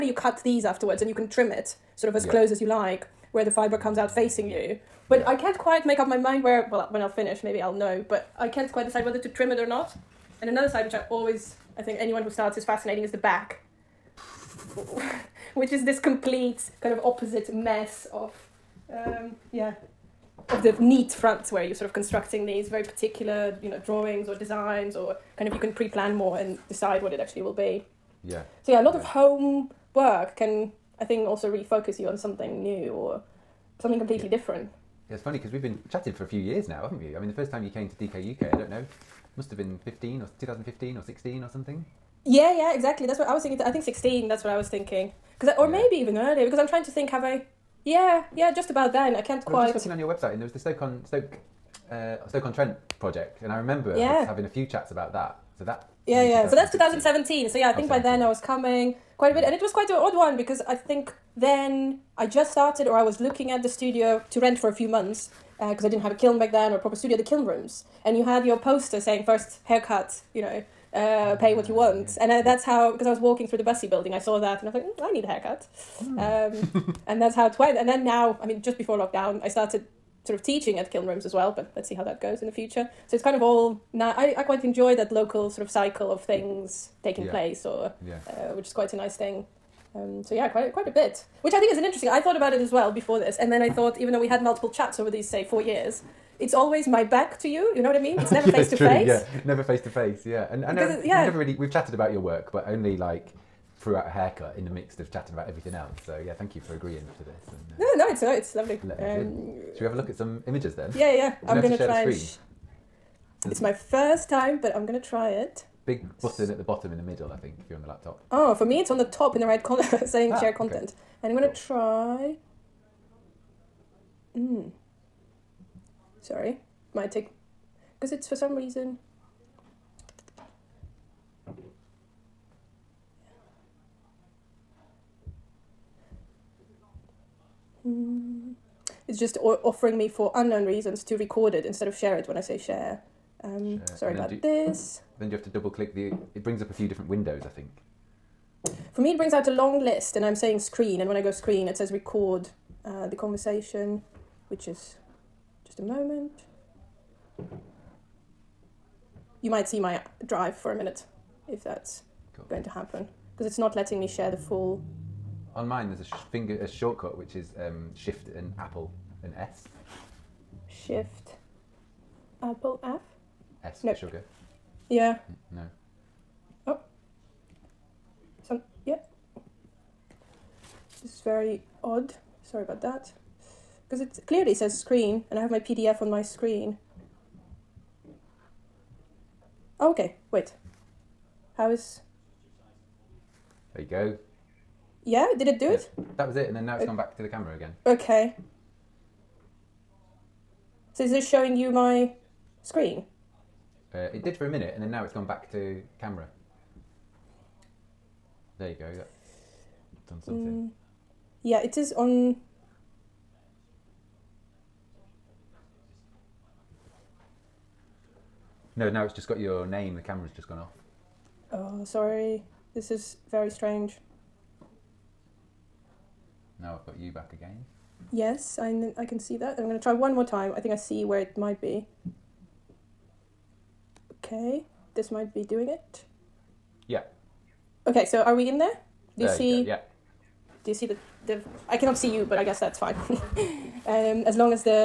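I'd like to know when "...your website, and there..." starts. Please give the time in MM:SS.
00:49.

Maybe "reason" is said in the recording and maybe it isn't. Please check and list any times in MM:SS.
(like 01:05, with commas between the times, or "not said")
02:08, 02:20.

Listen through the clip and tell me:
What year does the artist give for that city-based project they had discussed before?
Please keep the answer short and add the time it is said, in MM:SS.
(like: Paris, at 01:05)
2017, at 00:56.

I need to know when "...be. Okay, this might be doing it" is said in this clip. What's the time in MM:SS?
03:51.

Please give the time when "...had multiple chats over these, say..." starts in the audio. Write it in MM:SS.
01:34.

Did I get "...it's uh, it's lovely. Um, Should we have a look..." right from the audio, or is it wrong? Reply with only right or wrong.
right.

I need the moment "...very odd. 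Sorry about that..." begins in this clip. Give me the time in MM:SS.
03:01.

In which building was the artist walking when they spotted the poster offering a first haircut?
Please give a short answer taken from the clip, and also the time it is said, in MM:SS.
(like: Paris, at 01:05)
Bussey building, at 01:13.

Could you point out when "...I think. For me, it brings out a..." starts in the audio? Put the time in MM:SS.
02:27.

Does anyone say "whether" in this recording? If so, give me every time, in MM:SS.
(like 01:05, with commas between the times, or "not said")
00:09.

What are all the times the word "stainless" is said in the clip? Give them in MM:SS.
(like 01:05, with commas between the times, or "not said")
not said.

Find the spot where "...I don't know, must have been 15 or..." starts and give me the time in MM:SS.
00:38.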